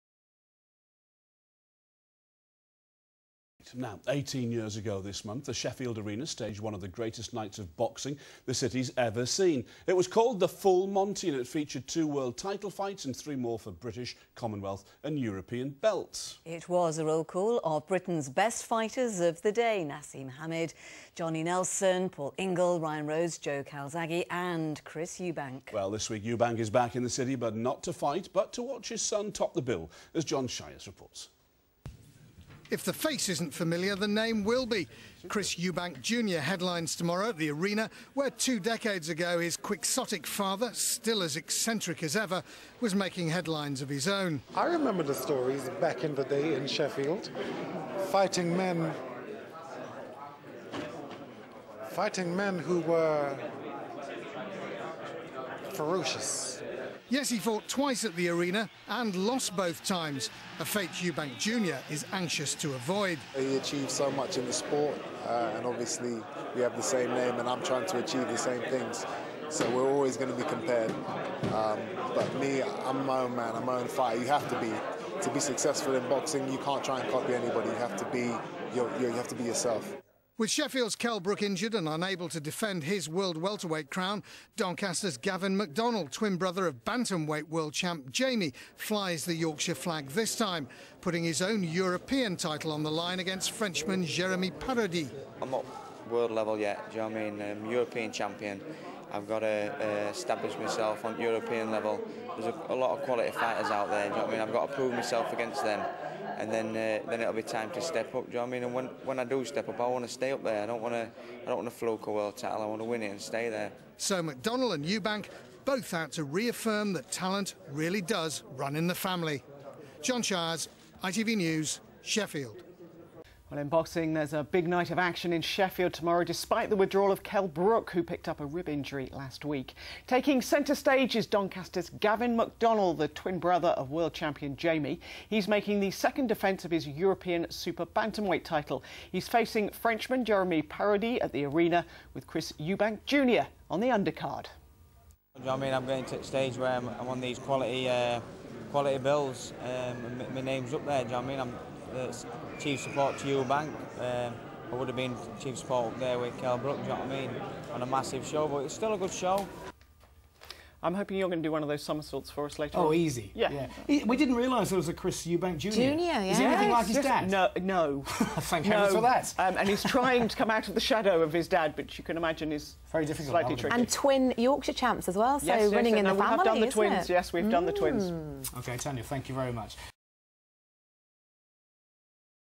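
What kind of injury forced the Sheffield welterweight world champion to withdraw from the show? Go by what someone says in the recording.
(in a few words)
rib injury.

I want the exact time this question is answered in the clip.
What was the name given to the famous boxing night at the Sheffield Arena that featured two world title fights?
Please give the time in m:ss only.
0:10.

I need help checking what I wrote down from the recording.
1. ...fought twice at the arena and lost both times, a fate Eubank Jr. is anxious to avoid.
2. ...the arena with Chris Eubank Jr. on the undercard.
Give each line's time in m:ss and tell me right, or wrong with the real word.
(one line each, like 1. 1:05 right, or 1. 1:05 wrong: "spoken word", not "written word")
1. 0:57 right
2. 2:21 right.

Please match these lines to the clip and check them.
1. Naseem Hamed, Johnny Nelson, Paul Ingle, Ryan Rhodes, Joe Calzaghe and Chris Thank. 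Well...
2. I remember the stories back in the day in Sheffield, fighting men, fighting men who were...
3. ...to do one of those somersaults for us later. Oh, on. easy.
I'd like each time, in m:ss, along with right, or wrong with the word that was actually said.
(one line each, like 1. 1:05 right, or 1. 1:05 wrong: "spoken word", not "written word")
1. 0:19 wrong: "Eubank", not "Thank"
2. 0:44 right
3. 2:41 right.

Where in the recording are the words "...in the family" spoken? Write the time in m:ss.
1:58.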